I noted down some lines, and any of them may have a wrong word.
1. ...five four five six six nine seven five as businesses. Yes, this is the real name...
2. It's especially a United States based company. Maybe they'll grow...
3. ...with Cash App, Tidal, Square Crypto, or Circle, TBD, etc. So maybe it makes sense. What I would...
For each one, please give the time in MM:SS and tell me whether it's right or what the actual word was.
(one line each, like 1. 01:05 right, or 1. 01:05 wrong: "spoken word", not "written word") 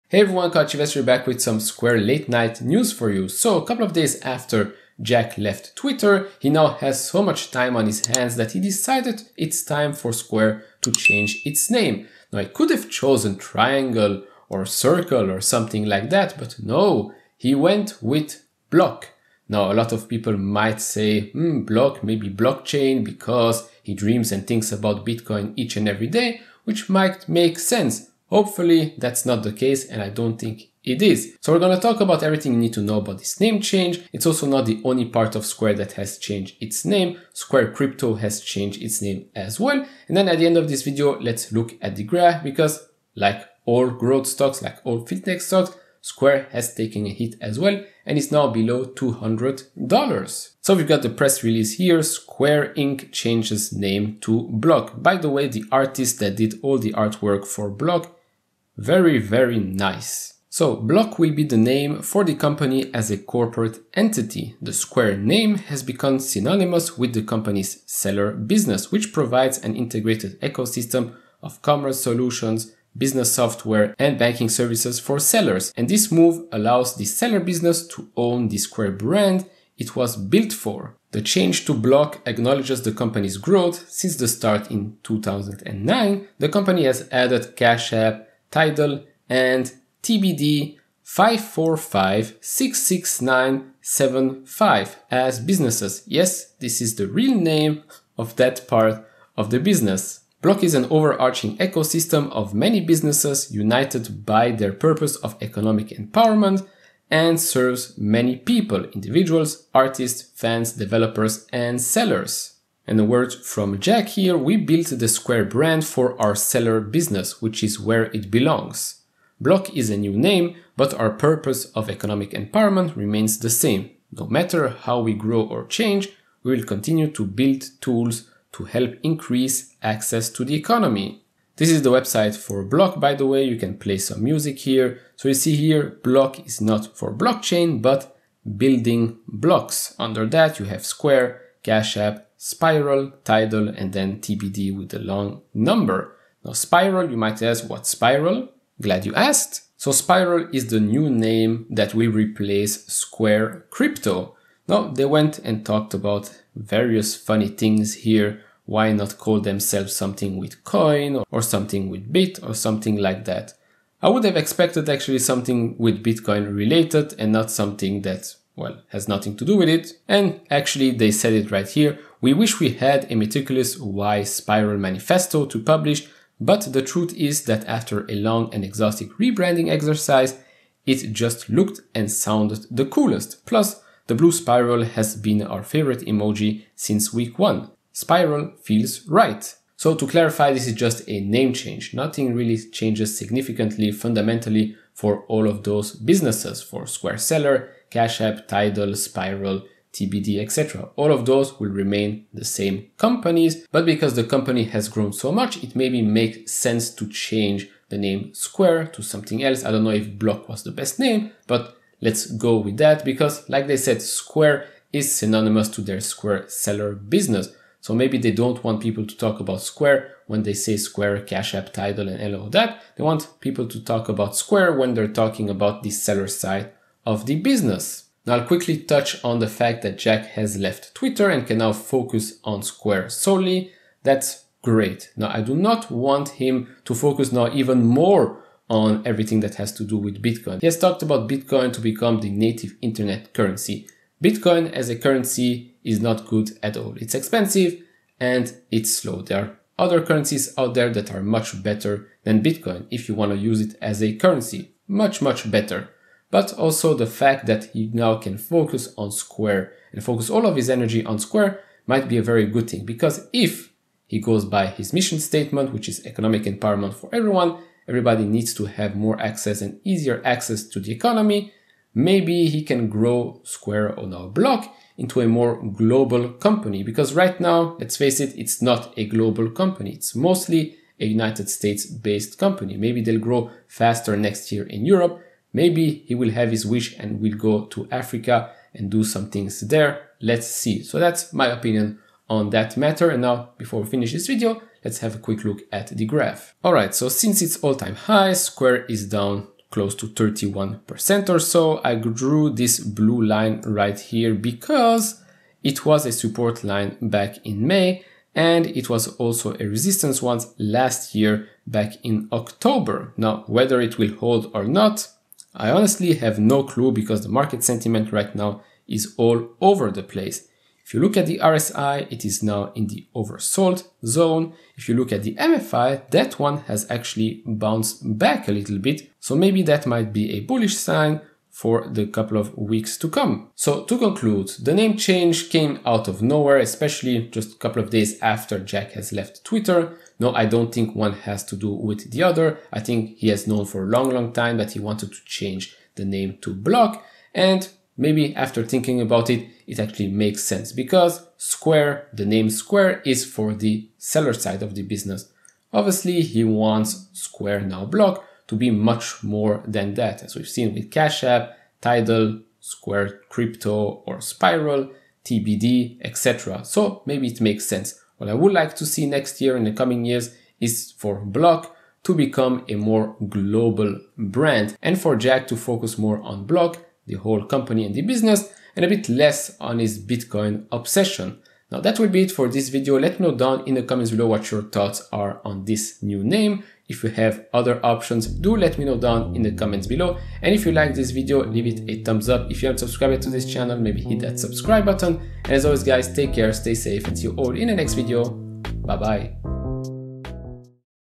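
1. 01:31 right
2. 04:39 wrong: "mostly", not "especially"
3. 06:00 wrong: "Spiral", not "Circle".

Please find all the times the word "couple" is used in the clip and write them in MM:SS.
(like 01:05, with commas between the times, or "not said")
00:03, 05:32, 05:37.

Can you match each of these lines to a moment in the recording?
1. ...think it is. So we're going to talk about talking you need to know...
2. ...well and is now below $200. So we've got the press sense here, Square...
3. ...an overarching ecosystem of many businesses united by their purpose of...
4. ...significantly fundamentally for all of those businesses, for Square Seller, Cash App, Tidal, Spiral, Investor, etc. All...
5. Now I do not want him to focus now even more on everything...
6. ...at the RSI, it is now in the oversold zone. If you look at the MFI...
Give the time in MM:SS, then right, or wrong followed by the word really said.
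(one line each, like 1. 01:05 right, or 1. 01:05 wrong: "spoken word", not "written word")
1. 00:30 wrong: "everything", not "talking"
2. 00:47 wrong: "release", not "sense"
3. 01:40 right
4. 03:13 wrong: "TBD", not "Investor"
5. 03:55 right
6. 05:21 right.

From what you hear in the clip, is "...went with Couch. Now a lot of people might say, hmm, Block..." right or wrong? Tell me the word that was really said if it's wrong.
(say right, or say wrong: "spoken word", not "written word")
wrong: "Block", not "Couch".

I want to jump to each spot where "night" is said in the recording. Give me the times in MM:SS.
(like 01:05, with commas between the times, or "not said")
00:02.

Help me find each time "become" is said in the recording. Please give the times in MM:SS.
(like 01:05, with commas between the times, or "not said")
01:05, 04:01, 06:12.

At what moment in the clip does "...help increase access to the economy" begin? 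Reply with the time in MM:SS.
02:08.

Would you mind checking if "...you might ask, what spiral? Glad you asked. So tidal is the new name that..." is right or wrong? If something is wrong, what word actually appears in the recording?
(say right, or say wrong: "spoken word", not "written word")
wrong: "spiral", not "tidal".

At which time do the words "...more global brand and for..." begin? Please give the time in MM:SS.
06:12.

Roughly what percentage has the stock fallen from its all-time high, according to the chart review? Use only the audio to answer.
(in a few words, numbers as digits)
31%.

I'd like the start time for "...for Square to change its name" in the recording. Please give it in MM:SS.
00:09.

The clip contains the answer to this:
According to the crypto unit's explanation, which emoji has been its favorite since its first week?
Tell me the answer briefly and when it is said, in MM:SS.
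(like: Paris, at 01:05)
blue spiral, at 03:04.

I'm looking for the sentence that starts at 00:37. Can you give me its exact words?
Square Crypto has changed its name as well.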